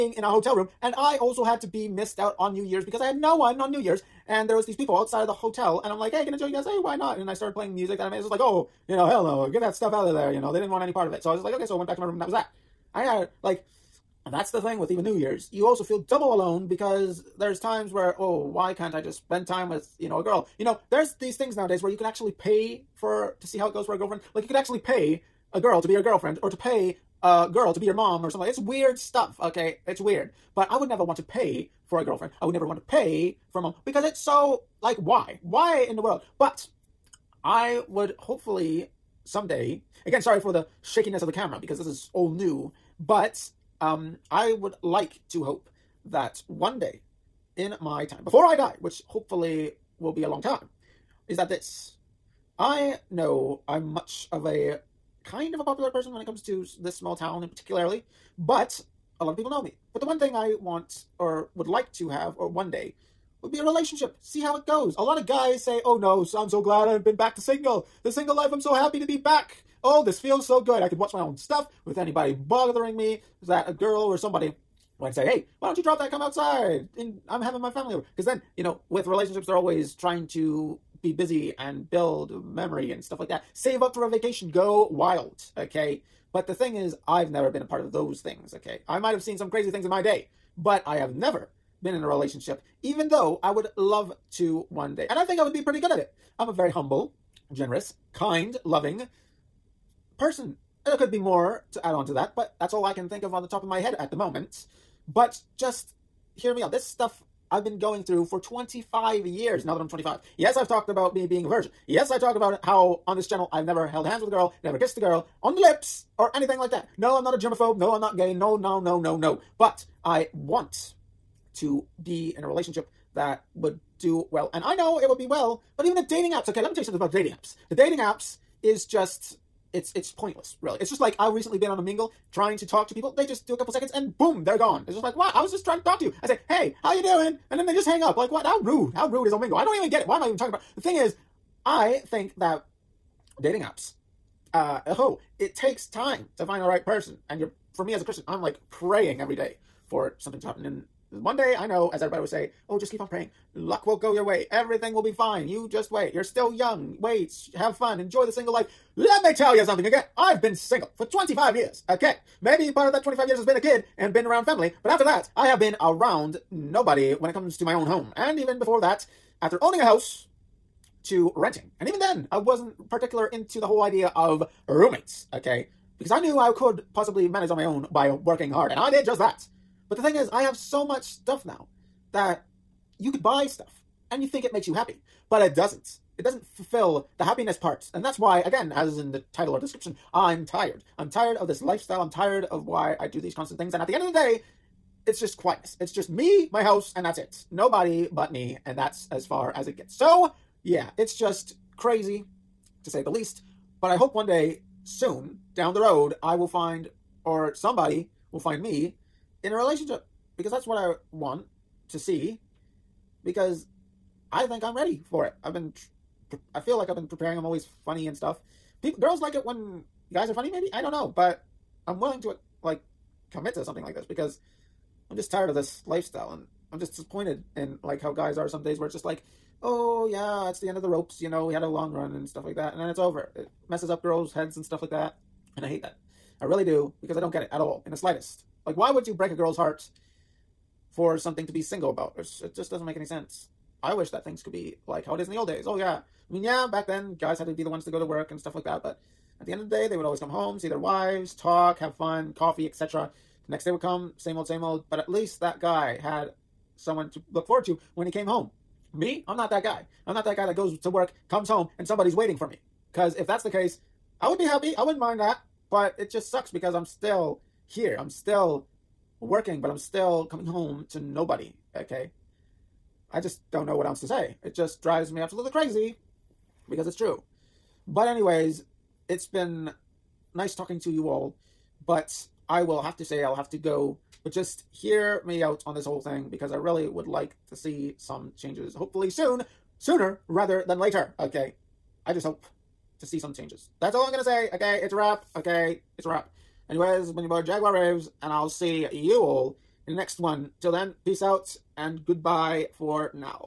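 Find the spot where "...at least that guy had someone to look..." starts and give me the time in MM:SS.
04:14.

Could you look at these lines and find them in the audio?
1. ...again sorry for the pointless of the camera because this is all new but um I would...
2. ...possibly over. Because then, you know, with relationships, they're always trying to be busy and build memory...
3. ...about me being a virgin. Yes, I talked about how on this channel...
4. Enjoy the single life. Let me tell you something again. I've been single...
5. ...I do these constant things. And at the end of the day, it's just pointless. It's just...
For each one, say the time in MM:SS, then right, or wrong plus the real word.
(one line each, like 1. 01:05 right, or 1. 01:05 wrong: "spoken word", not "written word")
1. 00:40 wrong: "shakiness", not "pointless"
2. 01:17 wrong: "family", not "possibly"
3. 01:50 right
4. 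02:37 right
5. 03:12 wrong: "quietness", not "pointless".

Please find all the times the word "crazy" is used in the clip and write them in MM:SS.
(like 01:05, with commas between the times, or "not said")
01:29, 03:21, 04:35.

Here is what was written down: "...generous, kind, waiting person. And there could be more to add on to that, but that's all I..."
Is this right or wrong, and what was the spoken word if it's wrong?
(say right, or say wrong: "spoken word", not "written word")
wrong: "loving", not "waiting".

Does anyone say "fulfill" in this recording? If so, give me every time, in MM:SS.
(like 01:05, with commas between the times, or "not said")
03:06.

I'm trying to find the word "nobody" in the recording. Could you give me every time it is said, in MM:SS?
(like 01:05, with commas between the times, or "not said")
02:46, 03:17, 04:30.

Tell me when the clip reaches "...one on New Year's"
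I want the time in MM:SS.
00:03.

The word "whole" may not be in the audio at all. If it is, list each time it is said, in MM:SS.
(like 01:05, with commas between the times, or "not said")
02:53, 04:45.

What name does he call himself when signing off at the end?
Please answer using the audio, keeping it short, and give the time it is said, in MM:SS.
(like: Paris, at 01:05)
boy Jaguar Raves, at 04:57.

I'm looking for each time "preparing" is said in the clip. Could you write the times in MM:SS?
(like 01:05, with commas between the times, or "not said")
03:37.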